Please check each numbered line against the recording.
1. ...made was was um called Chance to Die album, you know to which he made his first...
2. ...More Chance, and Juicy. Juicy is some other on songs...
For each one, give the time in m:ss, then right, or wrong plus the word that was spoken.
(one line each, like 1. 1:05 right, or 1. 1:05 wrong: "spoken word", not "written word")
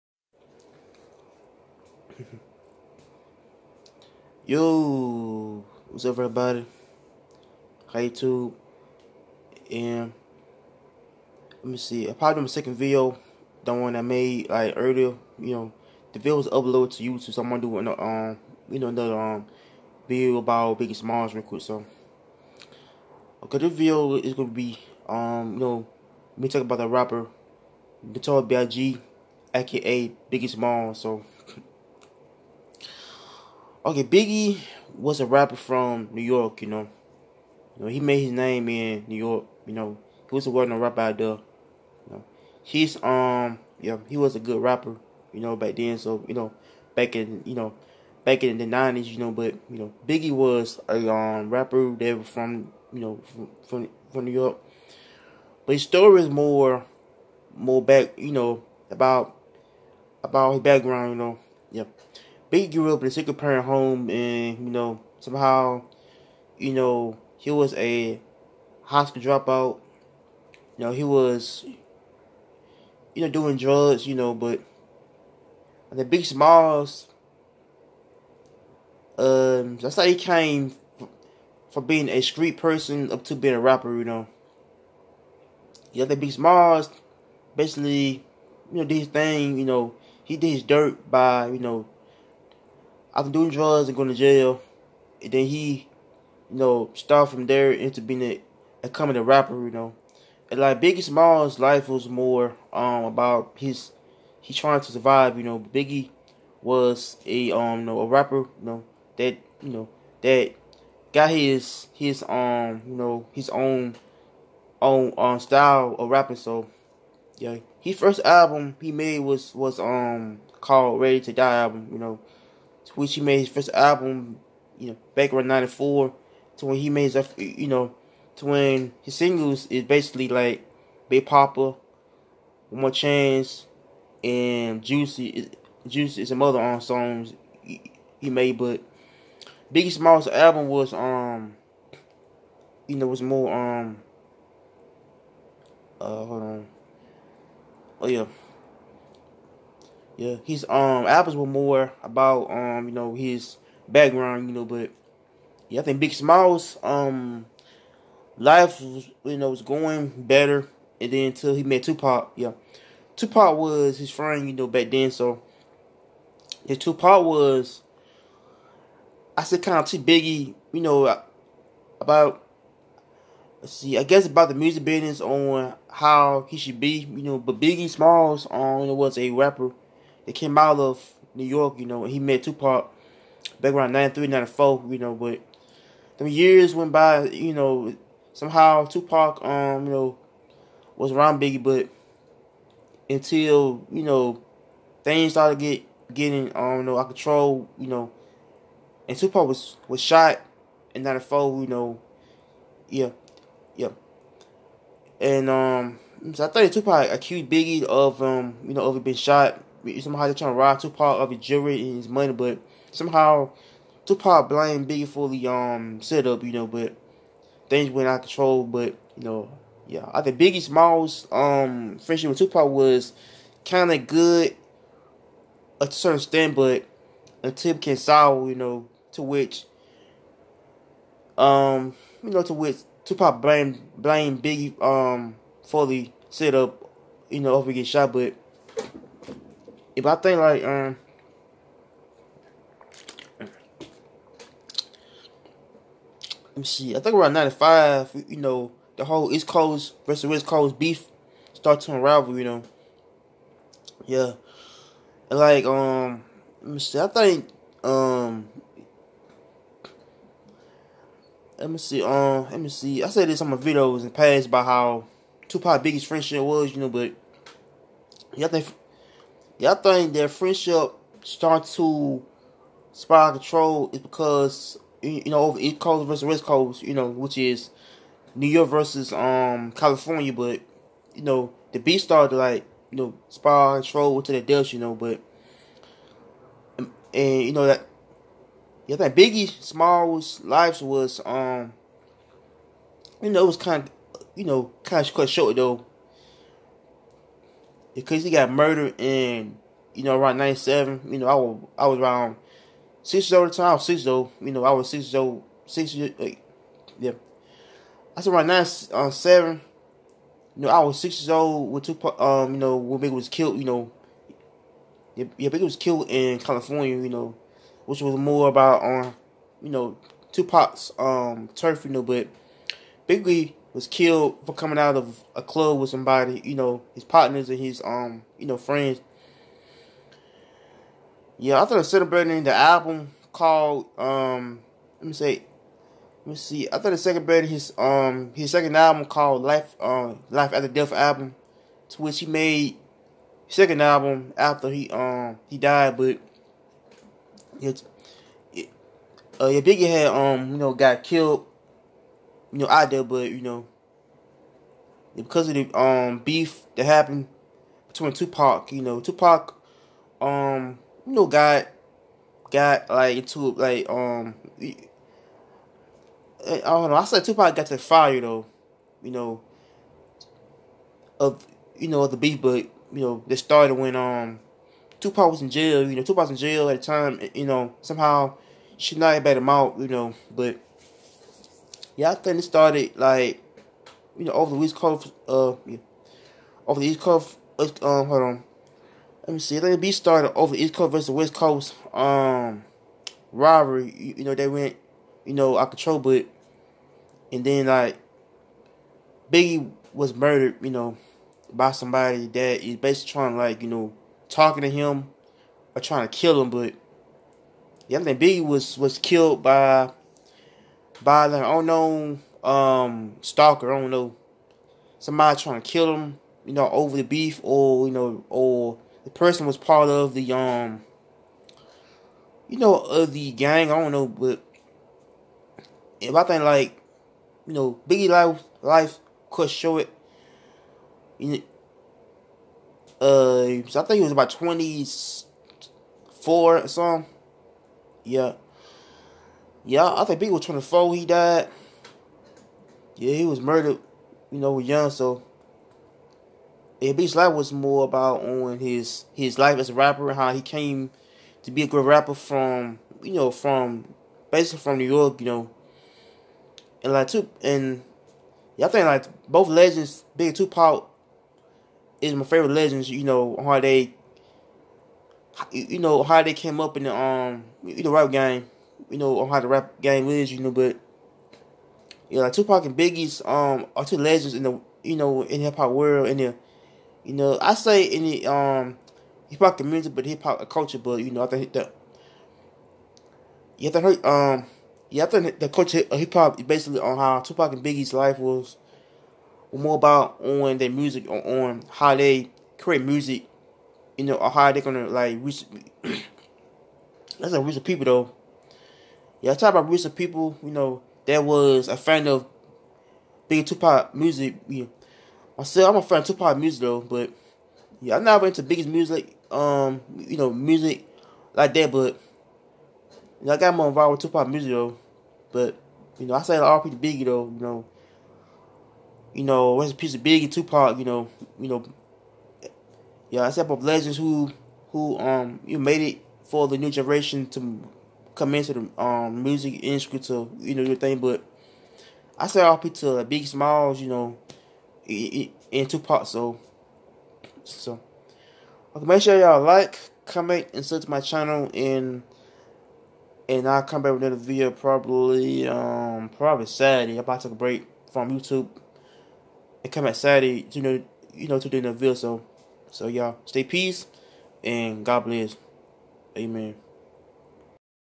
1. 1:58 wrong: "Ready", not "Chance"
2. 2:12 right.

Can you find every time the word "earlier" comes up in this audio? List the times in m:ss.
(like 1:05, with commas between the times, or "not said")
0:14.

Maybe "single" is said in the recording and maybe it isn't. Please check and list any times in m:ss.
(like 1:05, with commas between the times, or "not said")
1:03, 2:09.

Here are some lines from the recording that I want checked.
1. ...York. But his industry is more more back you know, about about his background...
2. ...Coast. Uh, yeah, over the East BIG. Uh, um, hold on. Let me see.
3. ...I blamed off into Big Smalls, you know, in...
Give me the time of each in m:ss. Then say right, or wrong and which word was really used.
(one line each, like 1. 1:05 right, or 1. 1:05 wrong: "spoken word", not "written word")
1. 0:54 wrong: "story", not "industry"
2. 6:24 wrong: "Coast", not "BIG"
3. 8:52 wrong: "started", not "blamed".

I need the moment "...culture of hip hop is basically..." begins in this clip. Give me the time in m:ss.
8:05.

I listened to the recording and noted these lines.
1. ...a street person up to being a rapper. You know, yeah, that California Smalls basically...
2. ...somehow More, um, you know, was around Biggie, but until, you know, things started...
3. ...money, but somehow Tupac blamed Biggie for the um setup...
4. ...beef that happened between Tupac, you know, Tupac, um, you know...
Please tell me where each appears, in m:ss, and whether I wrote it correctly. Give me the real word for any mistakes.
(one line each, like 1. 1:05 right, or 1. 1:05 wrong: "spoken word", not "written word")
1. 1:22 wrong: "Big", not "California"
2. 3:08 wrong: "Tupac", not "More"
3. 3:32 right
4. 5:56 right.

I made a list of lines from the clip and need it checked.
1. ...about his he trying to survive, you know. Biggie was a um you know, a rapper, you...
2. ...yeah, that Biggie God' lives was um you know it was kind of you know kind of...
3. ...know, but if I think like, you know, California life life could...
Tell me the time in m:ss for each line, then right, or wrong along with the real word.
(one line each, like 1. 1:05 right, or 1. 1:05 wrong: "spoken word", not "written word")
1. 1:43 right
2. 4:48 wrong: "Smalls", not "God"
3. 7:03 wrong: "Biggie", not "California".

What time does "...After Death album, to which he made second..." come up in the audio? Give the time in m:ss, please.
5:40.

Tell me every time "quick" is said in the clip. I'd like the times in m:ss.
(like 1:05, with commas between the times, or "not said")
0:21.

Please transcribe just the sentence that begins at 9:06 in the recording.
I'm about to take a break from YouTube and come back Saturday, you know, you know, to do another video.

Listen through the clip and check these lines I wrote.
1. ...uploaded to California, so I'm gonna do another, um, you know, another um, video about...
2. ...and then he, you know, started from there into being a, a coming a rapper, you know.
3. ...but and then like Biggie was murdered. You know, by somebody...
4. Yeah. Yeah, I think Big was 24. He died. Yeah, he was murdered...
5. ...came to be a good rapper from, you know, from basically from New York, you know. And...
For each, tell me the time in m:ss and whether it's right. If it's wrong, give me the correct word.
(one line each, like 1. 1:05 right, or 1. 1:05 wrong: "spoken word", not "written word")
1. 0:16 wrong: "YouTube", not "California"
2. 1:35 right
3. 6:35 right
4. 7:18 right
5. 7:30 right.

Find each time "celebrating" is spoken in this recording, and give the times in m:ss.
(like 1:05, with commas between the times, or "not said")
5:31, 5:37.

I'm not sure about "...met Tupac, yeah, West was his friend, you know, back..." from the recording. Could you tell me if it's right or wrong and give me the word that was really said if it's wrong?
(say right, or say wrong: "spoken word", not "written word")
wrong: "Tupac", not "West".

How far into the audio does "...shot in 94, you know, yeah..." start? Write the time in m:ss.
3:20.